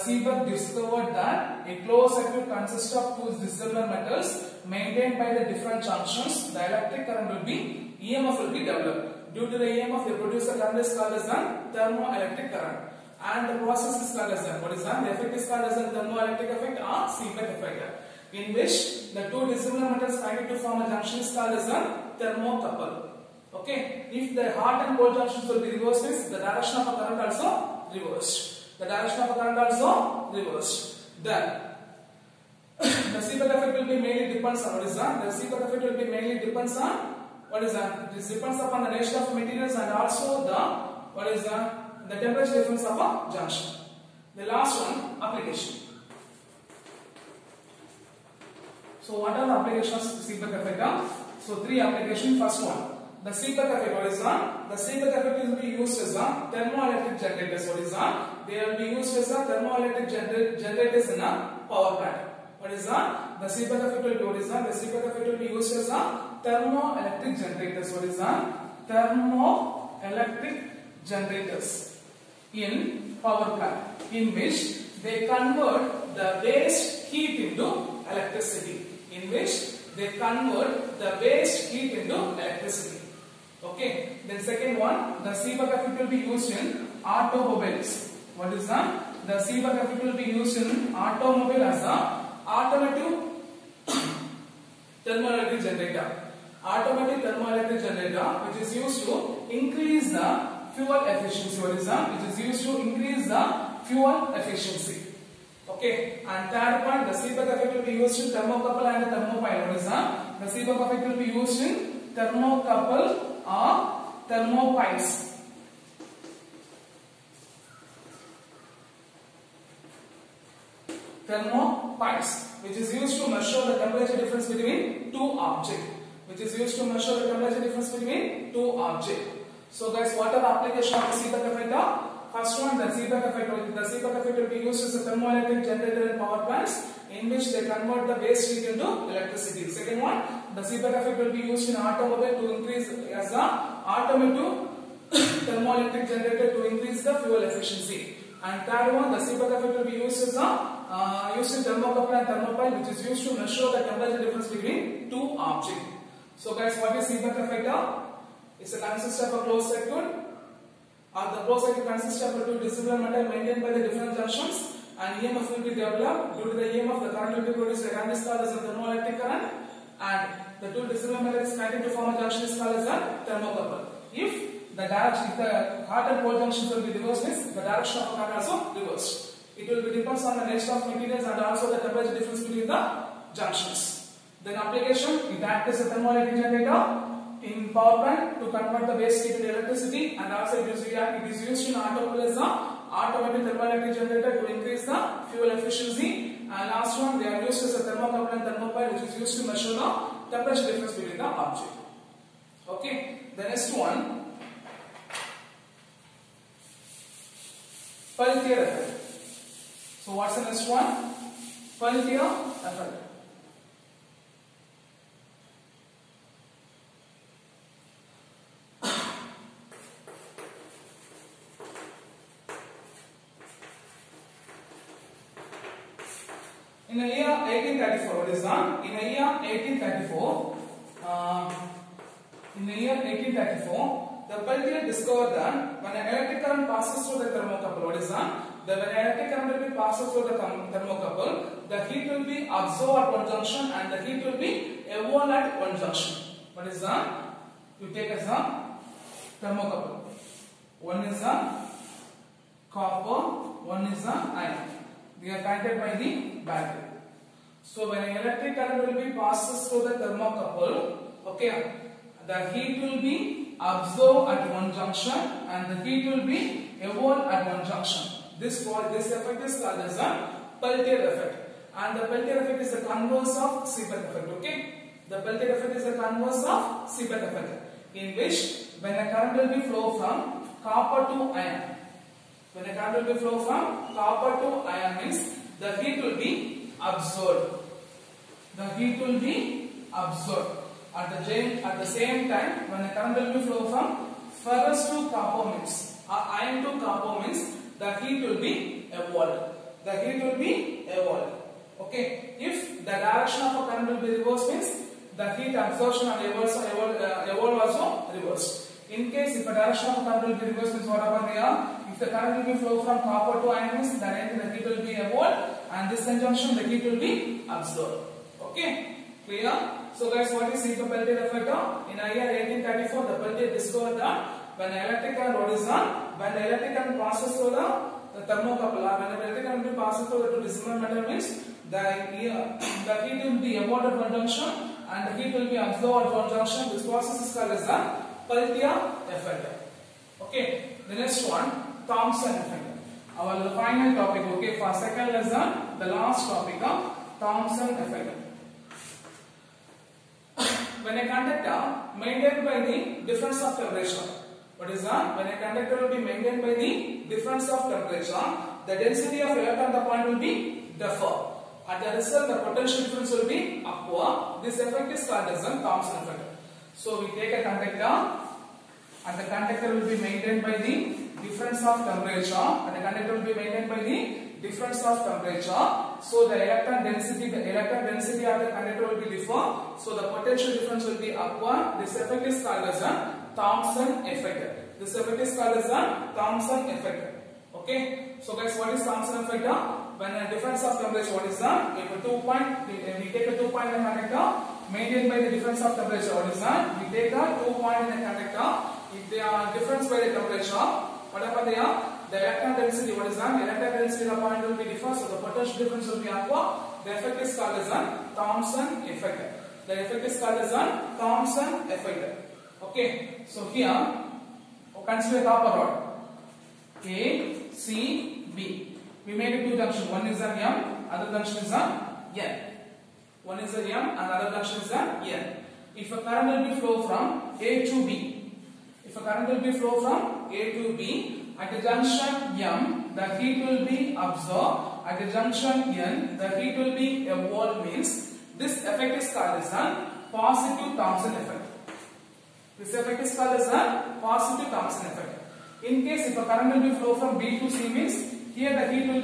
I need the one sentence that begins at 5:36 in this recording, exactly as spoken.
This process is called as the Peltier effect.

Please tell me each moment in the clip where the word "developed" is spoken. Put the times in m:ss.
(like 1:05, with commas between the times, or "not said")
0:08, 2:45.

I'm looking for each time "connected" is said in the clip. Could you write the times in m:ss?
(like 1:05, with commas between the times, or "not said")
2:51, 4:15.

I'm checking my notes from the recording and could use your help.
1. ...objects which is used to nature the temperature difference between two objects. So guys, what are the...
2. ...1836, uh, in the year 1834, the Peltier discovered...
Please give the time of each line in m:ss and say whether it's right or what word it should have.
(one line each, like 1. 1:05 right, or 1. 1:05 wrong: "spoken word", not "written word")
1. 2:05 wrong: "measure", not "nature"
2. 3:49 wrong: "1834", not "1836".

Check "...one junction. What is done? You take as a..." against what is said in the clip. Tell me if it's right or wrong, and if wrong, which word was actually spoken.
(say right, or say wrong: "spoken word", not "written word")
right.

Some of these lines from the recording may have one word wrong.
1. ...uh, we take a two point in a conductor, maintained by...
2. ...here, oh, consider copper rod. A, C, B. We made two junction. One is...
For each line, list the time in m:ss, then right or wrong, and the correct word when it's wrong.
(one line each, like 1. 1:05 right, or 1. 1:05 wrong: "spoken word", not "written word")
1. 6:32 right
2. 6:53 right.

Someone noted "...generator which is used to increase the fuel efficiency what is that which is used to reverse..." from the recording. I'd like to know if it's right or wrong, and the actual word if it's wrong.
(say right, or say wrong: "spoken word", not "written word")
wrong: "increase", not "reverse".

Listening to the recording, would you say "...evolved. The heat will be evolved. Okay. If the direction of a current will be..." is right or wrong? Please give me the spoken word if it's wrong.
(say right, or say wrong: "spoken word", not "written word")
right.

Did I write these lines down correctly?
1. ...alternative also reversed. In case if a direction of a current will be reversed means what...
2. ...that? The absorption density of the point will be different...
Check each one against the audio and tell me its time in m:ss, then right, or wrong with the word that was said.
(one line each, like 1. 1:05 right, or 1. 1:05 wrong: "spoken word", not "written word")
1. 5:07 wrong: "evolve", not "alternative"
2. 6:43 wrong: "electron", not "absorption".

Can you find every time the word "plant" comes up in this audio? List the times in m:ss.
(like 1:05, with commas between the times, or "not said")
1:01, 1:13, 2:16, 3:08.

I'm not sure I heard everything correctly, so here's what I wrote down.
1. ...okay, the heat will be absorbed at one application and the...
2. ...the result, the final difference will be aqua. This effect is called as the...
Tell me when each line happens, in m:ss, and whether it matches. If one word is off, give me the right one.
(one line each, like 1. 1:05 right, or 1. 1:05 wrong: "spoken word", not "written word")
1. 4:21 wrong: "junction", not "application"
2. 6:01 wrong: "potential", not "final".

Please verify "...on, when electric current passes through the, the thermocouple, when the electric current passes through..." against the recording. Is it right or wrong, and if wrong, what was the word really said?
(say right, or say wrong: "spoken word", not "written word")
right.